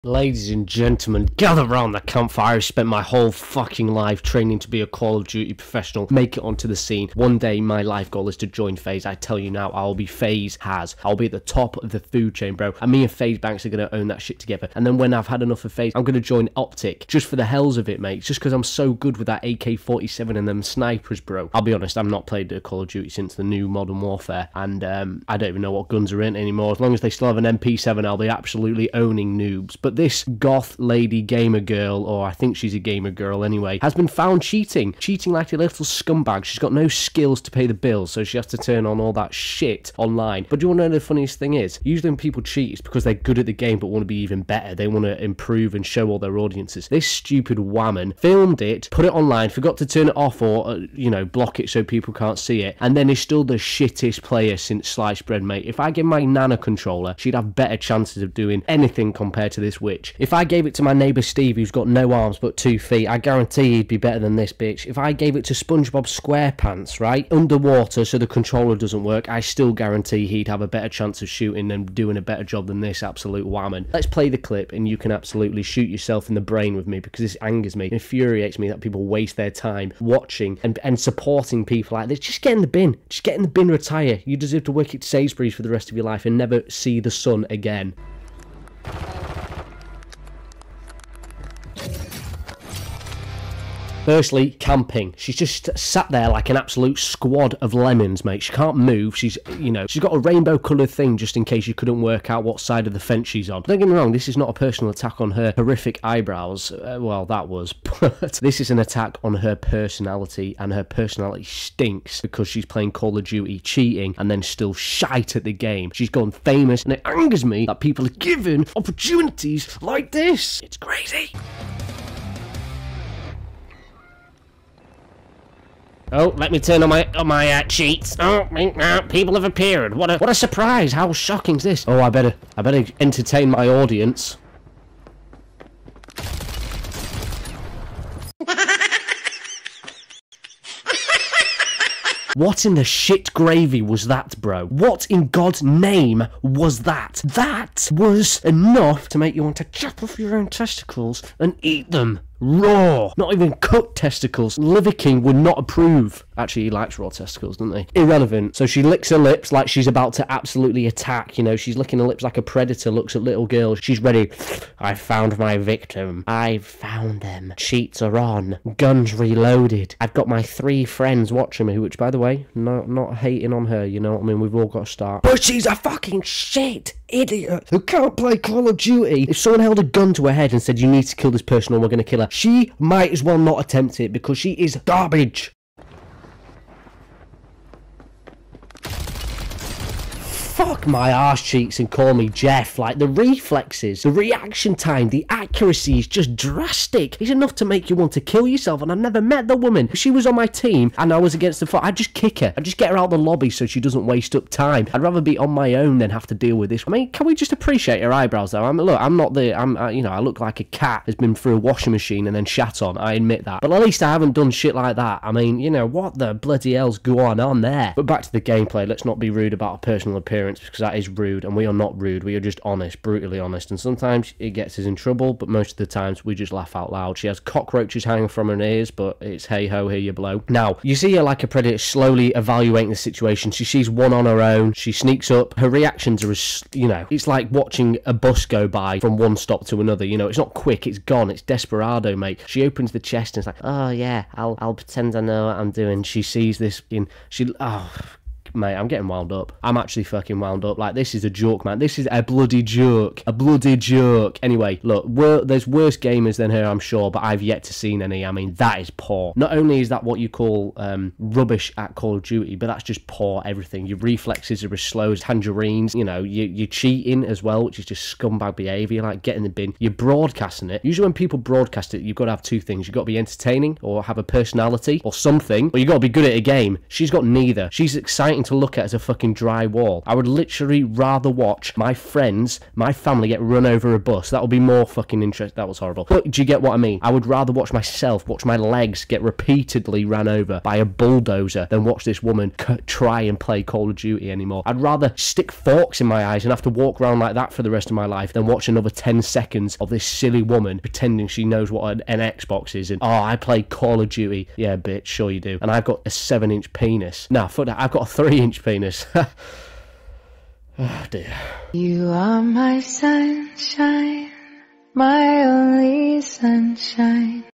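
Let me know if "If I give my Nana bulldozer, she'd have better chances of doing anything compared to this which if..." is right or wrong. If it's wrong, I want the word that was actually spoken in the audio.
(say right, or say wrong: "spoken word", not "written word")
wrong: "controller", not "bulldozer".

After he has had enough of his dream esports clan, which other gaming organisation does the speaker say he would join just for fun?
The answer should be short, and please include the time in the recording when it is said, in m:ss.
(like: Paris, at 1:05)
OpTic, at 0:16.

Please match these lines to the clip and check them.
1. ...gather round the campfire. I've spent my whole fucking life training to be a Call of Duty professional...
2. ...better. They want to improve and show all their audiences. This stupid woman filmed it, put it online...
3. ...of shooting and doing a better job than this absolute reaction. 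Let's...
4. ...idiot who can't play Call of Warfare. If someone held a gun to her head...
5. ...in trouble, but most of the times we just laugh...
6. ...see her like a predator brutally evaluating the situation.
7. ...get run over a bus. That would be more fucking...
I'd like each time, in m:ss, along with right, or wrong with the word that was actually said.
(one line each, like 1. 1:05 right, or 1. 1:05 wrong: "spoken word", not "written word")
1. 0:01 right
2. 0:44 right
3. 1:11 wrong: "whammon", not "reaction"
4. 2:57 wrong: "Duty", not "Warfare"
5. 3:44 right
6. 3:50 wrong: "slowly", not "brutally"
7. 4:43 right.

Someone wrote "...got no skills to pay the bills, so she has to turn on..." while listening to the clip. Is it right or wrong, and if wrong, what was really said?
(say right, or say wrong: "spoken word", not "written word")
right.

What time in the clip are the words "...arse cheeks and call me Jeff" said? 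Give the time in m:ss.
3:11.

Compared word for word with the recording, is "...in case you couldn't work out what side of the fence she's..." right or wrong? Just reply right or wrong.
right.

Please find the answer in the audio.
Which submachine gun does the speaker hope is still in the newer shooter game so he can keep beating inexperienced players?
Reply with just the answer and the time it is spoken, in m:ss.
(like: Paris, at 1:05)
MP7, at 0:27.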